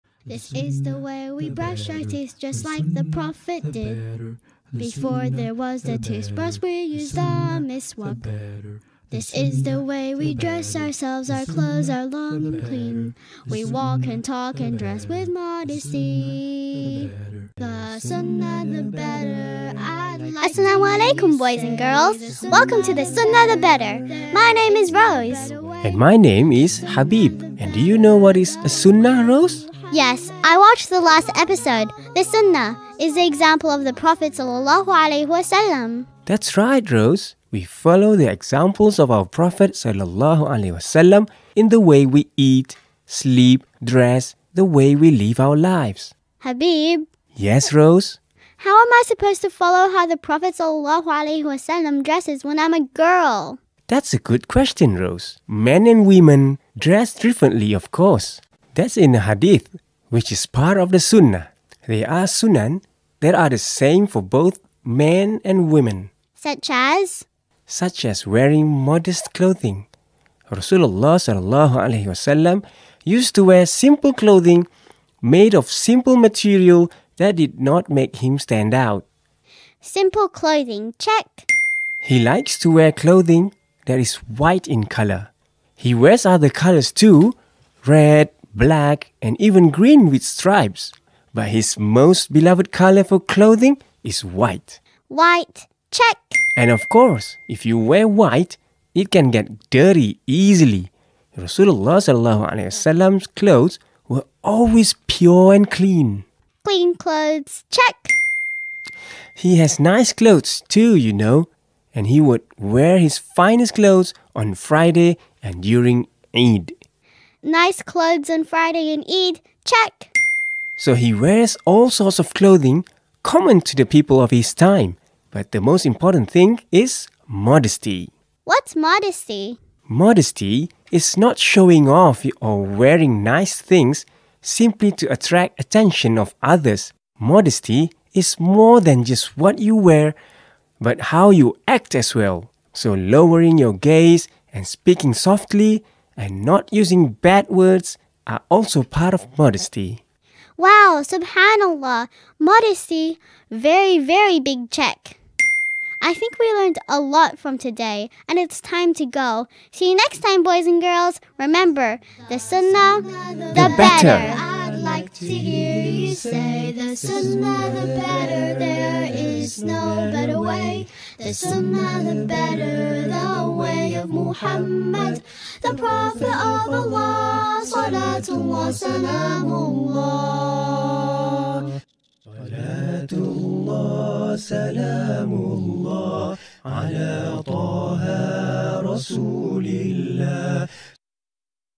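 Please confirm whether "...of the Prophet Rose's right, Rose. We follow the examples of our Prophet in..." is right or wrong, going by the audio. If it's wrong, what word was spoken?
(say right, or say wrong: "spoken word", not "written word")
wrong: "That", not "Rose".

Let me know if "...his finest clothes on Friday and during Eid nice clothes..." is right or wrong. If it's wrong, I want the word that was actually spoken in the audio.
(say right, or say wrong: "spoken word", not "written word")
right.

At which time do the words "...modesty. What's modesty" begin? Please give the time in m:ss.
2:07.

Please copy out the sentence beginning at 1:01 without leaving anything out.
They are sunan that are the same for both men and women.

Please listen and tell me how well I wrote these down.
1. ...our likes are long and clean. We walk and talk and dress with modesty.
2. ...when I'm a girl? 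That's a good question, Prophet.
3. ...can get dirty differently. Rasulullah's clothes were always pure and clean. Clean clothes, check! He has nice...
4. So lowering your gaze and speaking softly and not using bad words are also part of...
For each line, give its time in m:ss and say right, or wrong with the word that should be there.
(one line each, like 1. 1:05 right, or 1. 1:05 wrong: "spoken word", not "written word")
1. 0:11 wrong: "clothes", not "likes"
2. 0:52 wrong: "Rose", not "Prophet"
3. 1:39 wrong: "easily", not "differently"
4. 2:22 right.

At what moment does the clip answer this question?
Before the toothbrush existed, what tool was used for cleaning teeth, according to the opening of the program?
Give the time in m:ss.
0:07.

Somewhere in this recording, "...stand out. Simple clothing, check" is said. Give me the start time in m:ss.
1:18.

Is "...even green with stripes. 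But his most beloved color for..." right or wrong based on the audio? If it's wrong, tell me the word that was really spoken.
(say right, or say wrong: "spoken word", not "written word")
right.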